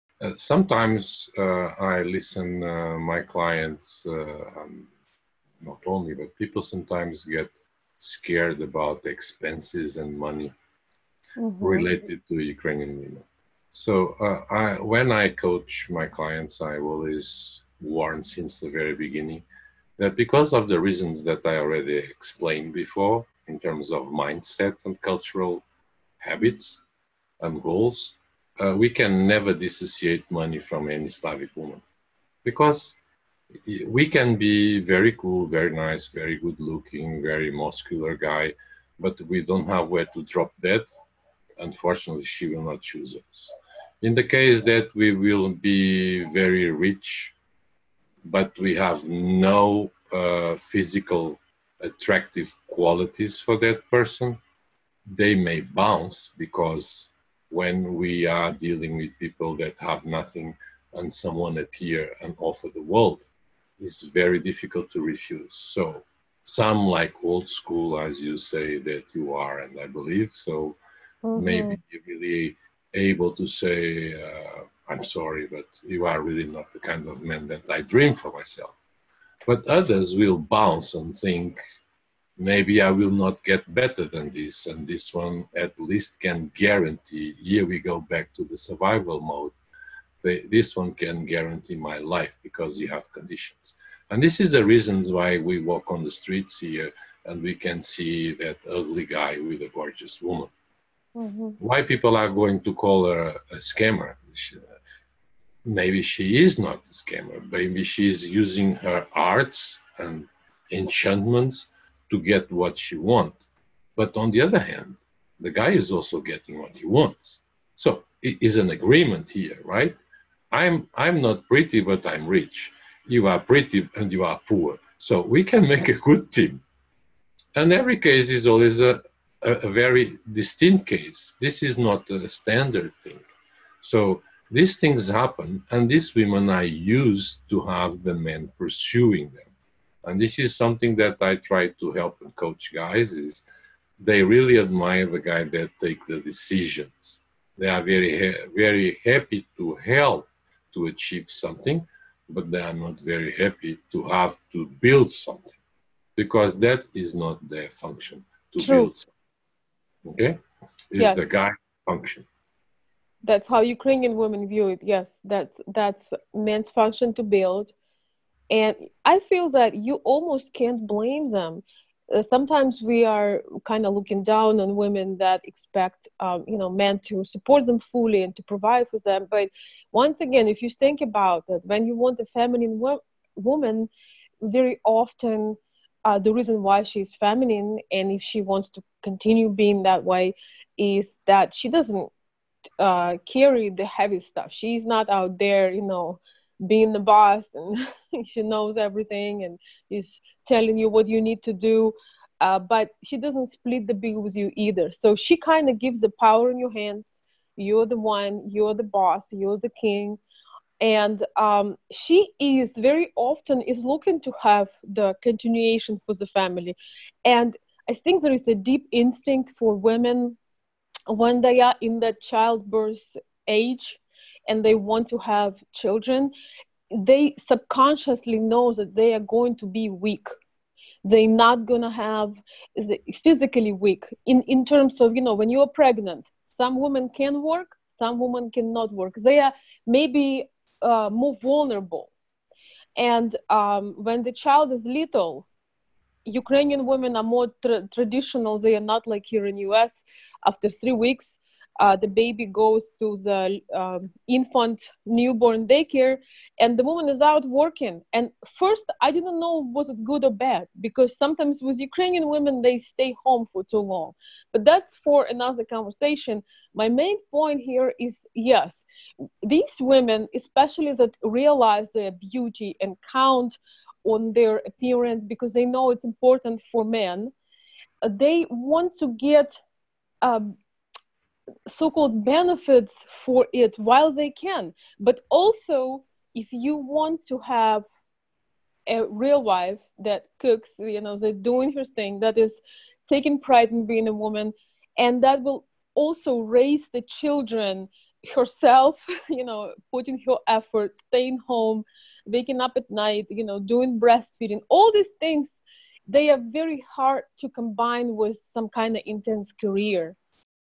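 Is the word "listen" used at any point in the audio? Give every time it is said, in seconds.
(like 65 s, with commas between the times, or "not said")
2 s.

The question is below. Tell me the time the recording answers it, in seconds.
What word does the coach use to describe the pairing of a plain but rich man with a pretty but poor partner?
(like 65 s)
118 s.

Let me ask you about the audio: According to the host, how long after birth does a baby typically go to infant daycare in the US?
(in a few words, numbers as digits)
3 weeks.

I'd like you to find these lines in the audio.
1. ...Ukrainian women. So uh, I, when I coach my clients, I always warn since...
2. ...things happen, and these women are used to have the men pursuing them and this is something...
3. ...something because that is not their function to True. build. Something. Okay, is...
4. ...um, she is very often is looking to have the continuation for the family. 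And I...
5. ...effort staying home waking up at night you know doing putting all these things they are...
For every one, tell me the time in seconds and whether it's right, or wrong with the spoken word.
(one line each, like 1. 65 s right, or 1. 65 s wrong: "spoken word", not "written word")
1. 12 s right
2. 134 s right
3. 155 s right
4. 211 s right
5. 300 s wrong: "breastfeeding", not "putting".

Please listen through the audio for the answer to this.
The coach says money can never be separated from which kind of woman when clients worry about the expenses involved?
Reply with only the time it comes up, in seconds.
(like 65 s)
31 s.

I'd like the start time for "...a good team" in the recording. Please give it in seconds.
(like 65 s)
125 s.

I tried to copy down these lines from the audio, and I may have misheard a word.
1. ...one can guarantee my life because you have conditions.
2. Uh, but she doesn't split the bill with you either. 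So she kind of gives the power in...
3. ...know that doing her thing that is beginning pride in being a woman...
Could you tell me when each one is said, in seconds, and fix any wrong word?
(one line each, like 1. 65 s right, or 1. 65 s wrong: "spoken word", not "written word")
1. 90 s right
2. 202 s right
3. 291 s wrong: "taking", not "beginning".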